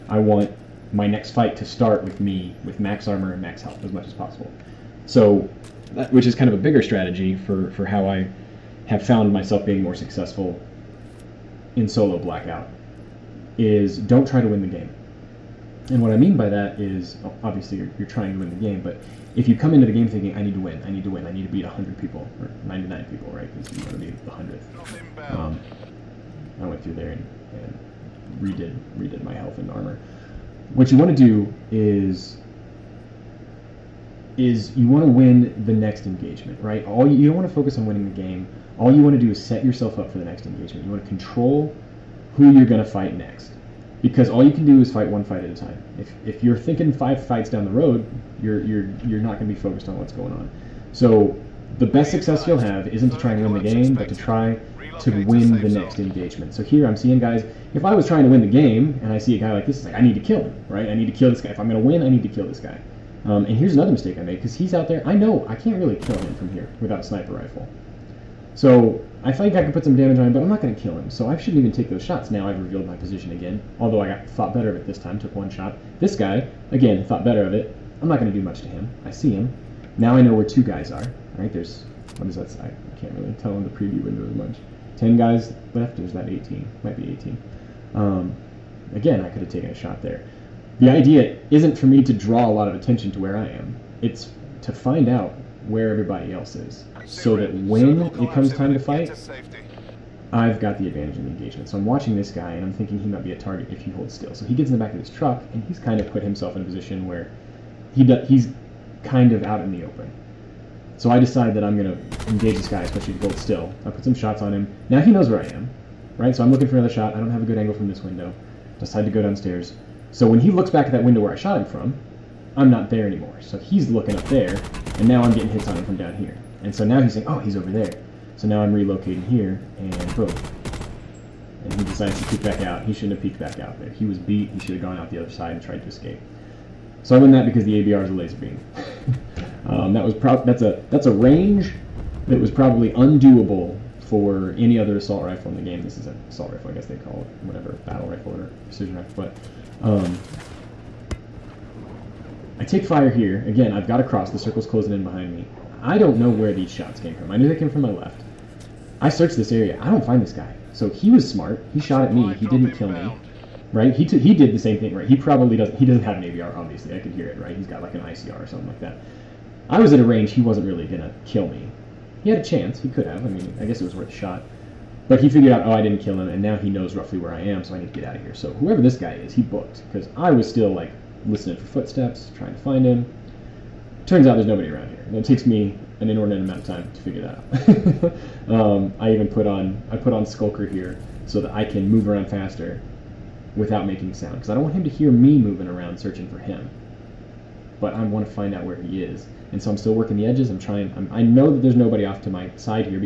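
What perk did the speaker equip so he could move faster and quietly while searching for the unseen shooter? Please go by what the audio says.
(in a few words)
Skulker.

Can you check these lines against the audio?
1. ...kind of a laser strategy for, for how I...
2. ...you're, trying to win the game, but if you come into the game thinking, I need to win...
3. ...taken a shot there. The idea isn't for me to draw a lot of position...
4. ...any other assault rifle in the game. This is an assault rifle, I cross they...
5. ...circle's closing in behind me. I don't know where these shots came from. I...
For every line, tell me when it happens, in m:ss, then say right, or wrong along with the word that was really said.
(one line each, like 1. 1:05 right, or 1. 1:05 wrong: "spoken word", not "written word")
1. 0:06 wrong: "bigger", not "laser"
2. 0:17 right
3. 1:29 wrong: "attention", not "position"
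4. 2:24 wrong: "guess", not "cross"
5. 2:34 right.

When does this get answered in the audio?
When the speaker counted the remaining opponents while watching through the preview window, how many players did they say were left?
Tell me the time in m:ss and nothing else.
1:24.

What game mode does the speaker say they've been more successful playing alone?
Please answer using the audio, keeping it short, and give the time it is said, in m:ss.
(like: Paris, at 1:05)
solo blackout, at 0:11.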